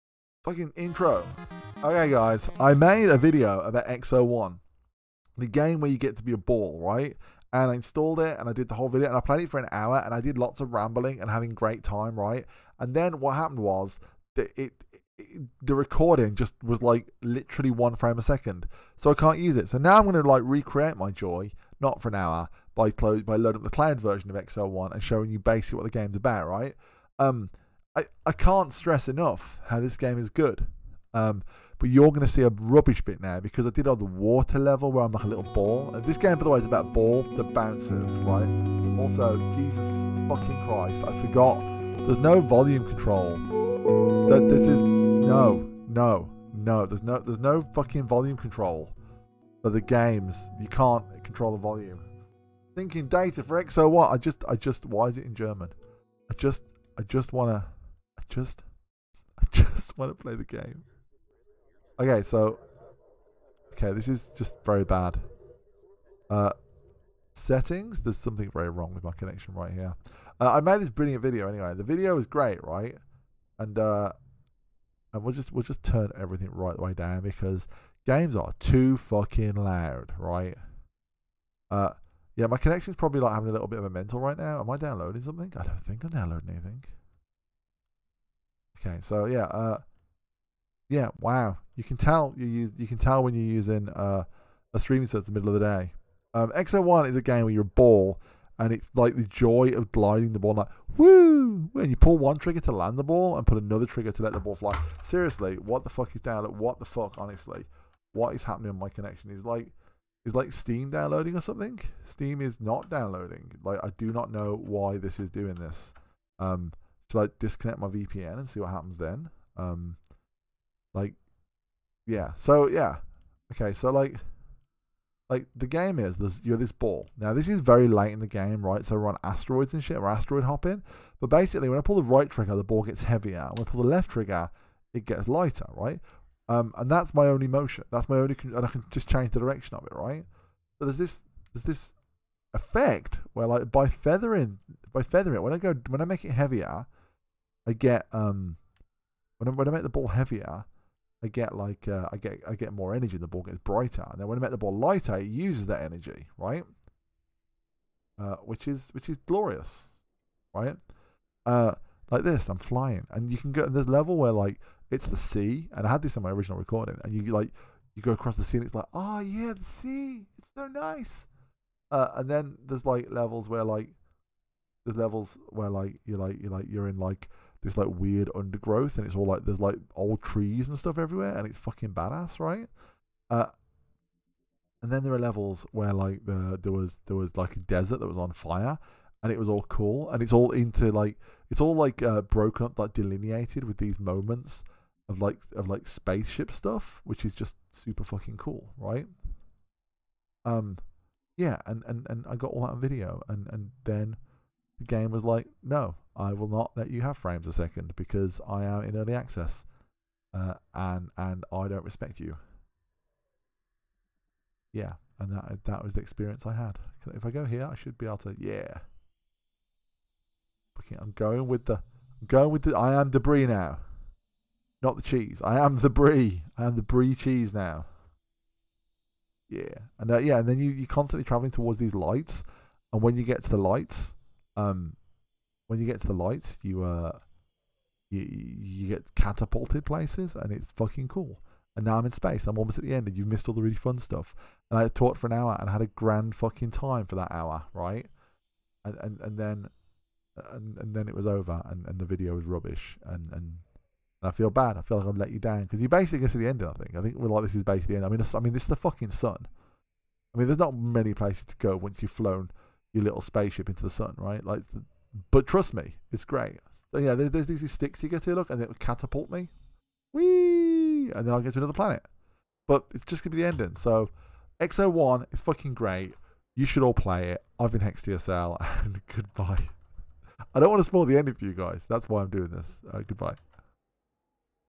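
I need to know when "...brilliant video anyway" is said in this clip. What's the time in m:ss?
1:10.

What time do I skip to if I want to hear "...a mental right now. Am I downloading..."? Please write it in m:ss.
1:23.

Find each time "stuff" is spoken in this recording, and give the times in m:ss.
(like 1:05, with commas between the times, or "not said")
3:00, 3:16, 4:03.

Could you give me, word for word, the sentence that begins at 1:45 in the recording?
Seriously, what the fuck is down what the fuck, honestly?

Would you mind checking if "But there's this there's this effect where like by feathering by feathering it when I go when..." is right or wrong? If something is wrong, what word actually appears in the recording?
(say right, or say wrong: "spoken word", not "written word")
right.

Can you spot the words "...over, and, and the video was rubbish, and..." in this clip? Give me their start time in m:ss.
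4:11.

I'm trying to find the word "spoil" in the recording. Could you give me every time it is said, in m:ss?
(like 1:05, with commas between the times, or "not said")
4:40.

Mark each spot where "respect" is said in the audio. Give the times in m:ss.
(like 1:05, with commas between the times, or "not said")
3:31.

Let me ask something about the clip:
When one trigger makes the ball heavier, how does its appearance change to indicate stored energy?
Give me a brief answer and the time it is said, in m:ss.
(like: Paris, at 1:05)
brighter, at 2:33.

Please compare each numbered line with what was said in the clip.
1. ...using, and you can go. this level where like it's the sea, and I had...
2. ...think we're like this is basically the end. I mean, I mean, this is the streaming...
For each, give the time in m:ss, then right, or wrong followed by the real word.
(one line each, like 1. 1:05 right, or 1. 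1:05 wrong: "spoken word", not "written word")
1. 2:42 wrong: "flying", not "using"
2. 4:17 wrong: "fucking", not "streaming".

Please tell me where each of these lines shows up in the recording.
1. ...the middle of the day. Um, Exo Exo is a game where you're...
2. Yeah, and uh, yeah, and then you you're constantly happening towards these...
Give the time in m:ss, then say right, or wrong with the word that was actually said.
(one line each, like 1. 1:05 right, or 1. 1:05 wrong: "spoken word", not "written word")
1. 1:35 wrong: "One", not "Exo"
2. 3:49 wrong: "traveling", not "happening".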